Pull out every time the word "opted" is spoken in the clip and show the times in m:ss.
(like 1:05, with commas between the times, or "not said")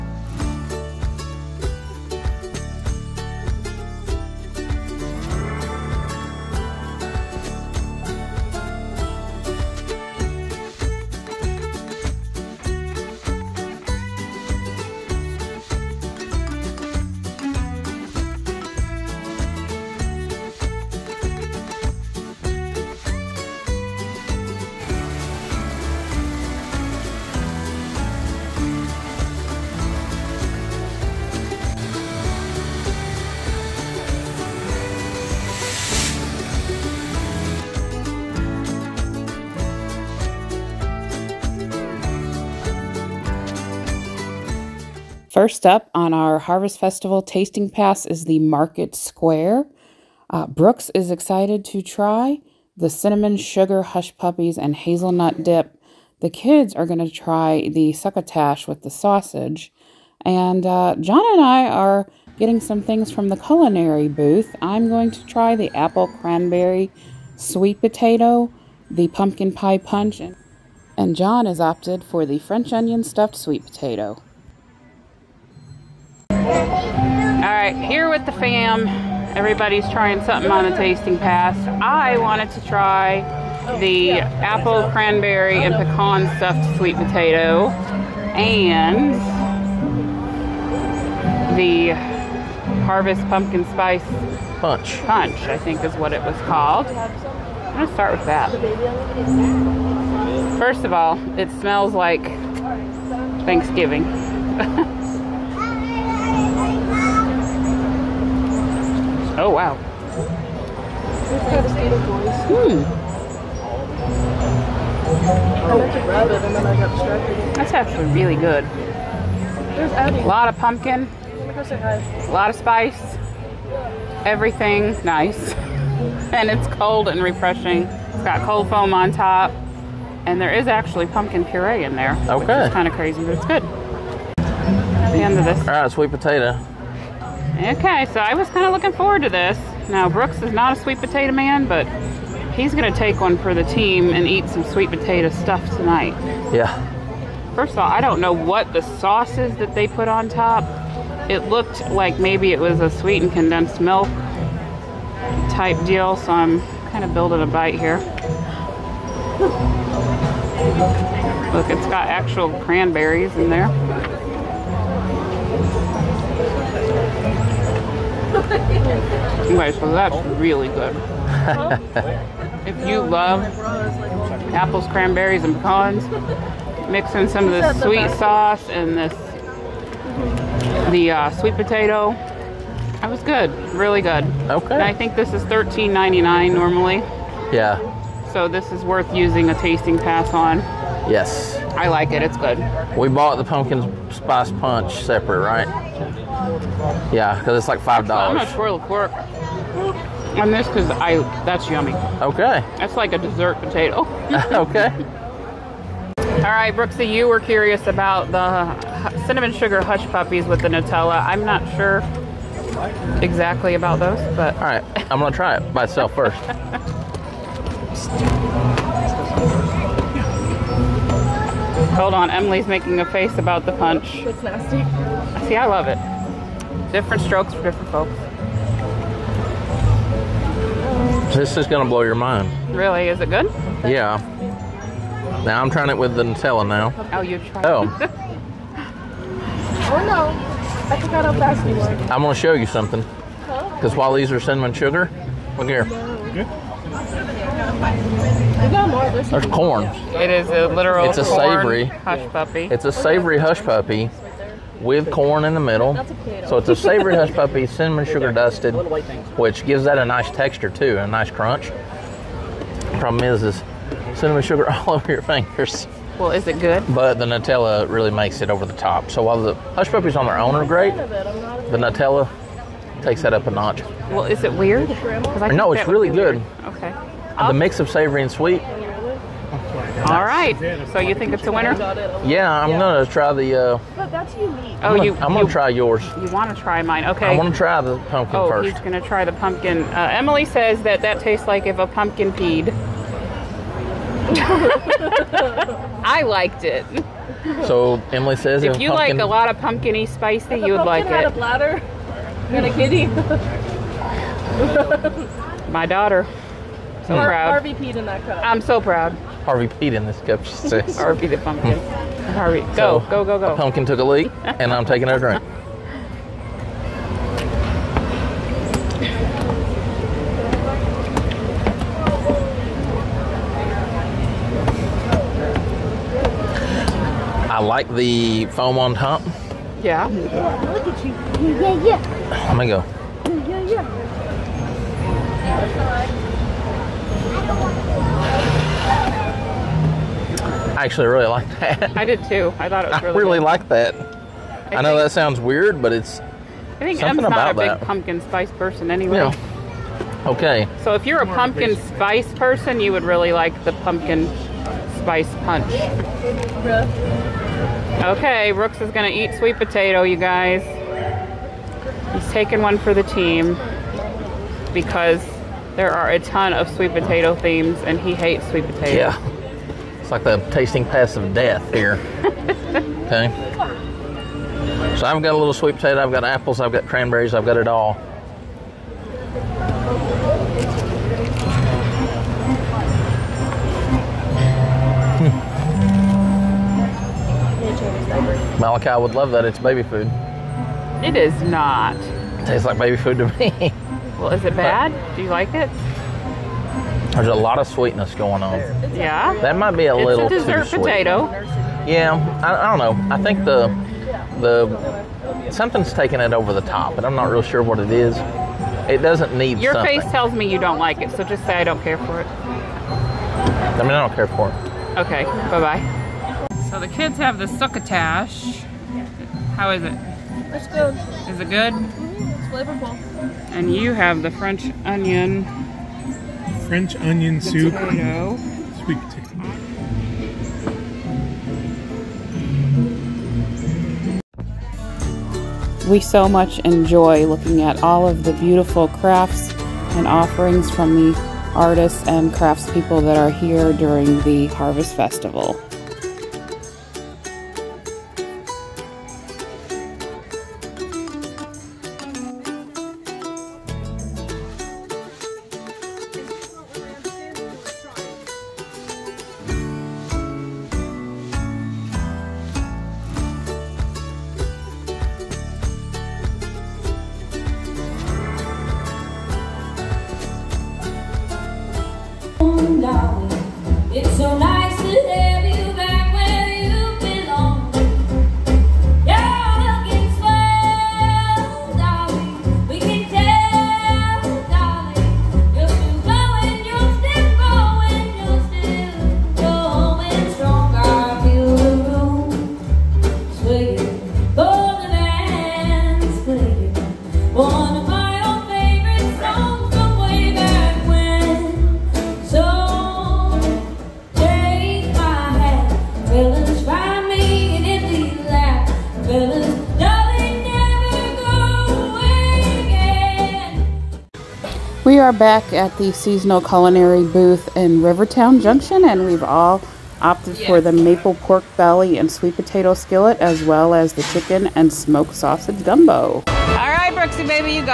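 1:11, 8:40.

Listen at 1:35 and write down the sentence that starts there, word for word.
Punch, I think is what it was called.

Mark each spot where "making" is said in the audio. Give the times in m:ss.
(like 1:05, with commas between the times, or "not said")
3:42.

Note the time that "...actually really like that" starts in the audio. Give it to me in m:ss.
5:40.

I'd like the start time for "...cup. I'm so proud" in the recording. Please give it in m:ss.
5:08.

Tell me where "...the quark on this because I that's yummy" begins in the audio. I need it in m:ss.
3:18.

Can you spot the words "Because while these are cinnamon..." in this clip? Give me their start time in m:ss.
4:03.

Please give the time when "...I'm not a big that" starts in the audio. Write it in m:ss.
5:47.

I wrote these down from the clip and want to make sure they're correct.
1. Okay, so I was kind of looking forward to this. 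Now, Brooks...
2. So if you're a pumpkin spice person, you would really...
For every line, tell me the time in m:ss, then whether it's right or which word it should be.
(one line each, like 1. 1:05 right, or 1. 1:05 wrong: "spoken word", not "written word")
1. 2:17 right
2. 5:50 right.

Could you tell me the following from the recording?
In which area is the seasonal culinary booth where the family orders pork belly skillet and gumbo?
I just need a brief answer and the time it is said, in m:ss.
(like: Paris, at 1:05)
Rivertown Junction, at 8:37.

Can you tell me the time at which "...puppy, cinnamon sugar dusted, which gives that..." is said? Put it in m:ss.
4:17.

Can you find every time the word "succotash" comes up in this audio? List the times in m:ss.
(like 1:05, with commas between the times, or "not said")
0:57, 6:57.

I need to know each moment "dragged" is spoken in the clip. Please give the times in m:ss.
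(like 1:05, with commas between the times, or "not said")
not said.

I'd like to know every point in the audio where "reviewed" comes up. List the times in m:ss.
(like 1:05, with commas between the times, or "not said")
not said.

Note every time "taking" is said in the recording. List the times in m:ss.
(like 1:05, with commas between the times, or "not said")
5:14, 6:02, 6:45.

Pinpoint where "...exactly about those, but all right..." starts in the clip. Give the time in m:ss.
3:33.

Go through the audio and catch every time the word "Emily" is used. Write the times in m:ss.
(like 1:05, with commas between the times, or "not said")
3:42, 4:50, 4:58.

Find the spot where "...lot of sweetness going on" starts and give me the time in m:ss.
6:37.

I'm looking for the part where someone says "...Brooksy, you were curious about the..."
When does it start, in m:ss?
3:26.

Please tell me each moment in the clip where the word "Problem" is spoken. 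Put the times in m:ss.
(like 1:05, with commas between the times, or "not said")
4:22.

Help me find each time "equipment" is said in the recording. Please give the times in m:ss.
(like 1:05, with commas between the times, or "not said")
not said.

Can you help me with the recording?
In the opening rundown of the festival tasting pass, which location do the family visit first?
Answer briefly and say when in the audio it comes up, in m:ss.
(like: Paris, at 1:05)
Market Square, at 0:48.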